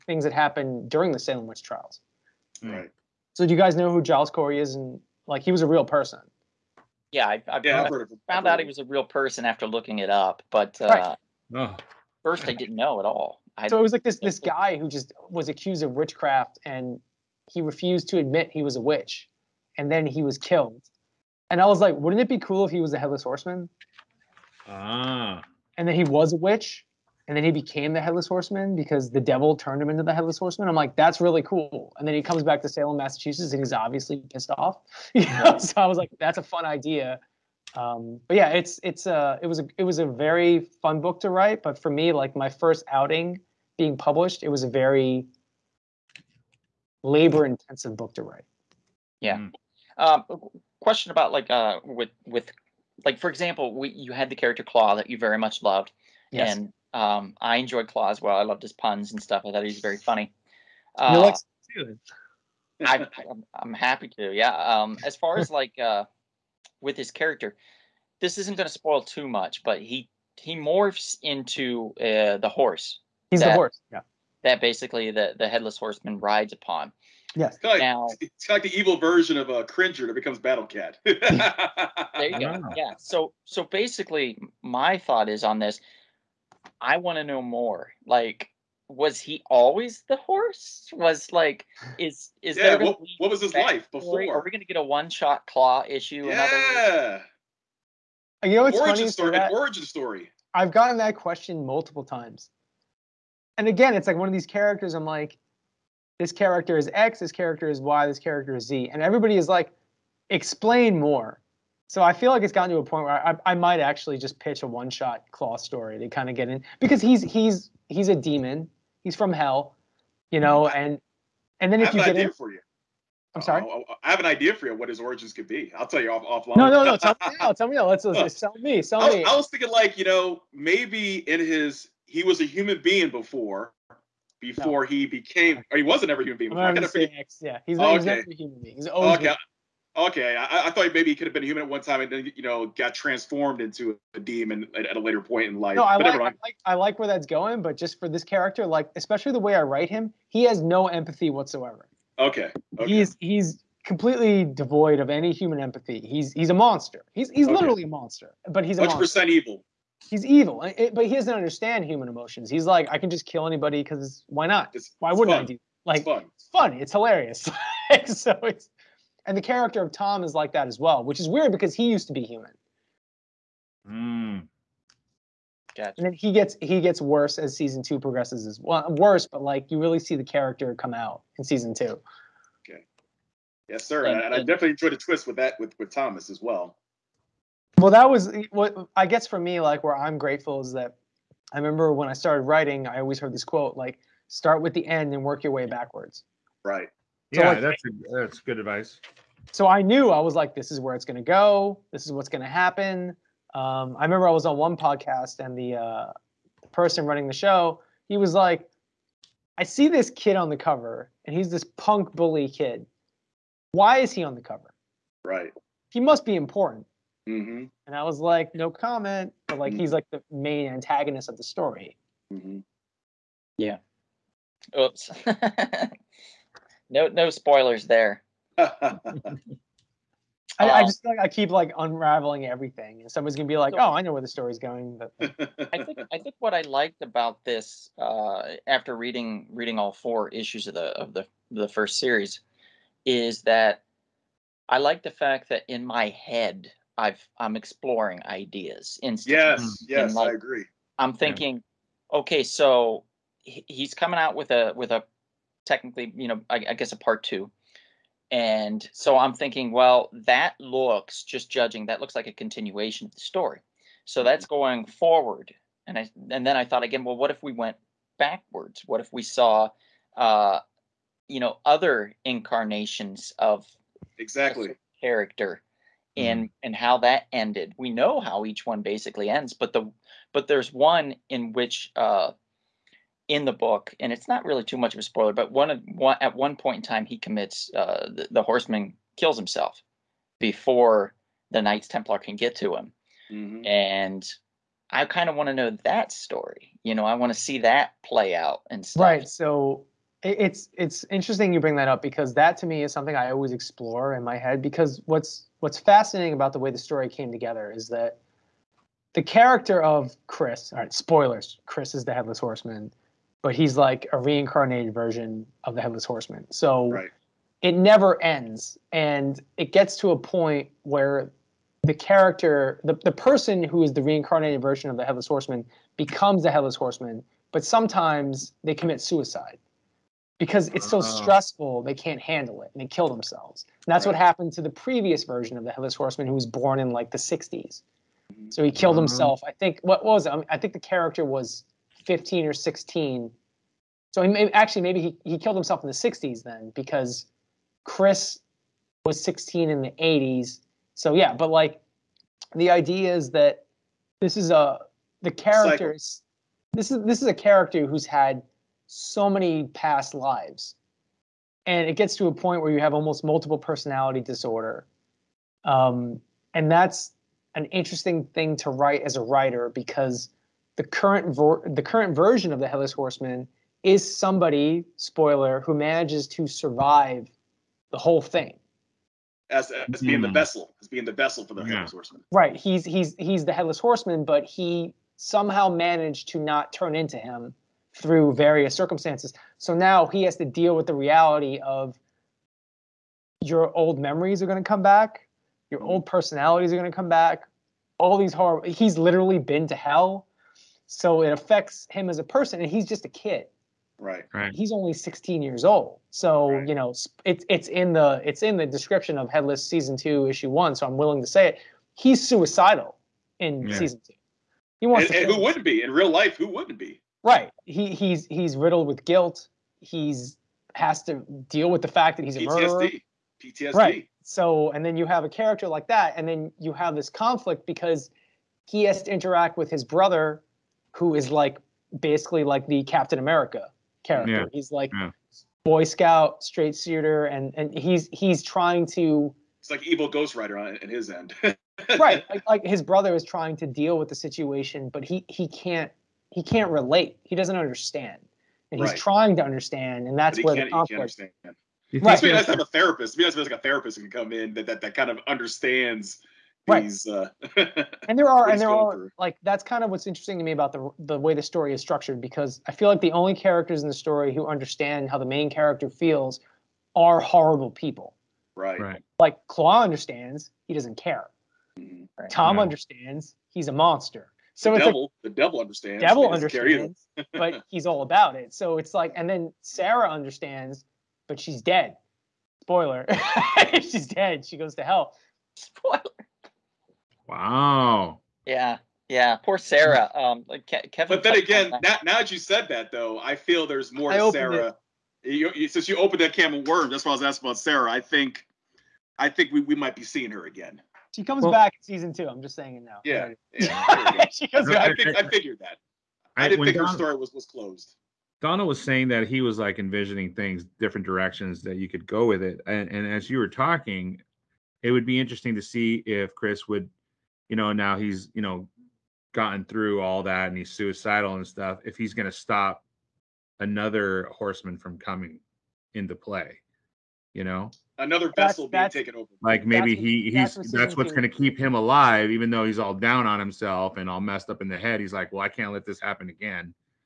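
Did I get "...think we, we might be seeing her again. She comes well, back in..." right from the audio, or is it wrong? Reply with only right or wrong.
right.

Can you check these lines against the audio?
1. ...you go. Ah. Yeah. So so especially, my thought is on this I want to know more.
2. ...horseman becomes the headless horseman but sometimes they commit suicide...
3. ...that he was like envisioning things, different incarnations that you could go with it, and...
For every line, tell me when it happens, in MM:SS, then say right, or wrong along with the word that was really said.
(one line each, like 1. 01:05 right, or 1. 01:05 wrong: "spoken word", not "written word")
1. 01:22 wrong: "basically", not "especially"
2. 05:25 right
3. 08:29 wrong: "directions", not "incarnations".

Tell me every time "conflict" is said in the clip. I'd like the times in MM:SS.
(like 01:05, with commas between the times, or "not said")
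07:07, 07:30.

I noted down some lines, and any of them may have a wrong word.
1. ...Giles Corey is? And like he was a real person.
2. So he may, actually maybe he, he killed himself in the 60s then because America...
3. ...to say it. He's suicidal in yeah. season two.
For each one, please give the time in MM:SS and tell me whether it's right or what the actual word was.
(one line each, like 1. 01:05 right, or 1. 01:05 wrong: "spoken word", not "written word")
1. 00:04 right
2. 05:44 wrong: "Chris", not "America"
3. 06:51 right.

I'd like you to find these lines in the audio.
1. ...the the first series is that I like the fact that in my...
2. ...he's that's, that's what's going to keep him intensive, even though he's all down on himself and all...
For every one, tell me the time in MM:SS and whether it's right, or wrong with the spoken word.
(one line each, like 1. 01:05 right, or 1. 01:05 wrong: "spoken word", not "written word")
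1. 04:01 right
2. 08:50 wrong: "alive", not "intensive".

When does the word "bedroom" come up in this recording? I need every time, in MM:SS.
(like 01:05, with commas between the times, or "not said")
not said.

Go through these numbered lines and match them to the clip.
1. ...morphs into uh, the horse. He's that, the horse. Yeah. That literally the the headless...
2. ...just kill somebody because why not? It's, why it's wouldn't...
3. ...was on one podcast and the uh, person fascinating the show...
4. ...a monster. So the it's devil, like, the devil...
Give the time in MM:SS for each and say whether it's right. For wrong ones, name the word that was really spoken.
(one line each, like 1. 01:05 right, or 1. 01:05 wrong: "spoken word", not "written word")
1. 01:10 wrong: "basically", not "literally"
2. 02:43 wrong: "anybody", not "somebody"
3. 03:24 wrong: "running", not "fascinating"
4. 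07:53 right.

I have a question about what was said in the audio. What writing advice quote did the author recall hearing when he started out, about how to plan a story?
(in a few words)
start with the end.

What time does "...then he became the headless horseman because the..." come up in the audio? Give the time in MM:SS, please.
00:27.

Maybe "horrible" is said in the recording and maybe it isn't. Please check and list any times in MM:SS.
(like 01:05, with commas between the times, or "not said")
06:38, 07:47.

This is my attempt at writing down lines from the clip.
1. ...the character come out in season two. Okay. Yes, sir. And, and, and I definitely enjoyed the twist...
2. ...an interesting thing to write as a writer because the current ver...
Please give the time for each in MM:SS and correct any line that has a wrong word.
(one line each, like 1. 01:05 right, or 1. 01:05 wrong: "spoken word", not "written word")
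1. 03:00 right
2. 06:07 right.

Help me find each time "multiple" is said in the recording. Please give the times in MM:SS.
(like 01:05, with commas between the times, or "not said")
01:41, 06:03.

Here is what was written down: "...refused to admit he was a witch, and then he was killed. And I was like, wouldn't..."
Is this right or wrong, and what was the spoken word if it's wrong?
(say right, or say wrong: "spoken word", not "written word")
right.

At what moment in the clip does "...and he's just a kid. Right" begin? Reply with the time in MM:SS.
06:42.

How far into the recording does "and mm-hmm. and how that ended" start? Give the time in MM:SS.
04:36.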